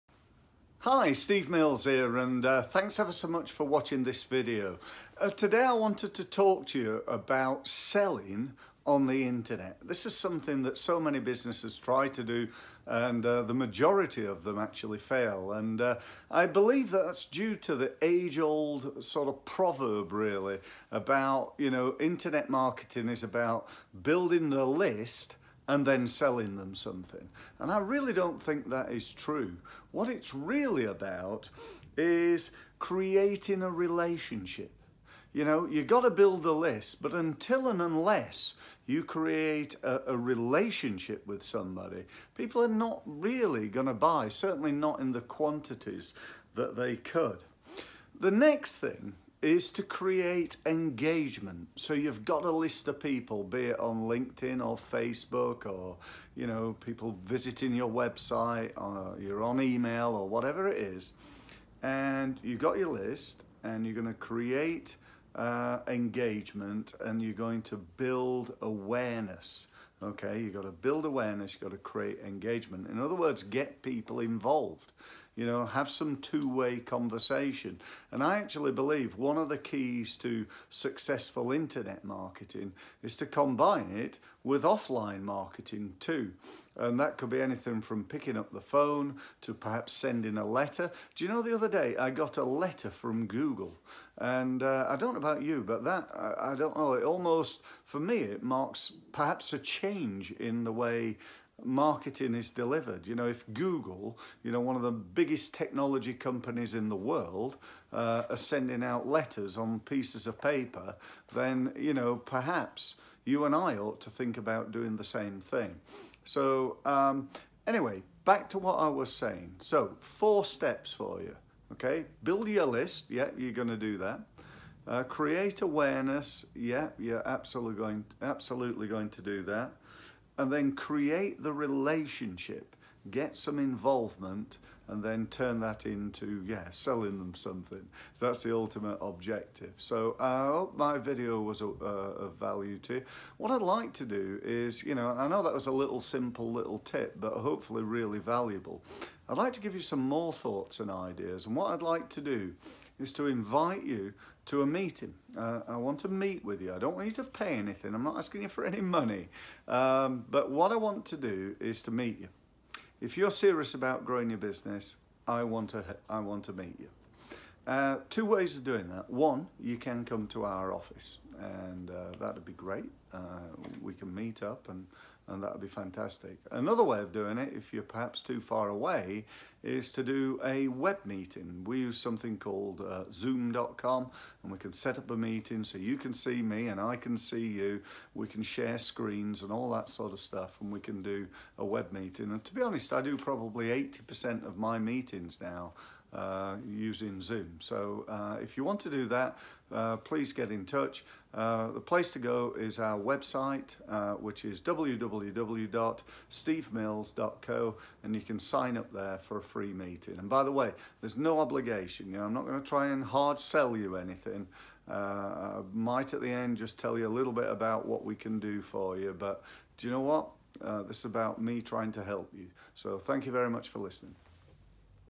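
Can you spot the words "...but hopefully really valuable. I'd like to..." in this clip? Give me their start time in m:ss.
2:27.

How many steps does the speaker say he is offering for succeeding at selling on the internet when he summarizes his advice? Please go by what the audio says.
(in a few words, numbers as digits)
4.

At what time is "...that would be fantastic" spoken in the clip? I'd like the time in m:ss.
2:55.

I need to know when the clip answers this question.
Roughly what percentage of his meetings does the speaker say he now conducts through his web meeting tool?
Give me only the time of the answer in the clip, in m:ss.
3:13.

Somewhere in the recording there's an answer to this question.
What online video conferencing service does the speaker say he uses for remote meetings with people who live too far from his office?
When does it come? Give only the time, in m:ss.
3:03.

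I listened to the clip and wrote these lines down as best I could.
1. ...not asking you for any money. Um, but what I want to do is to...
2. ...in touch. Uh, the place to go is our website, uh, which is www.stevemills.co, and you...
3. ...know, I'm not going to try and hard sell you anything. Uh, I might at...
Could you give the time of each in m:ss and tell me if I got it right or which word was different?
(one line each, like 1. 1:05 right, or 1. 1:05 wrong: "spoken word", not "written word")
1. 2:38 right
2. 3:20 right
3. 3:32 right.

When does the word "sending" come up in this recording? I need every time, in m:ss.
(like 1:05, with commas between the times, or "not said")
1:29, 1:48.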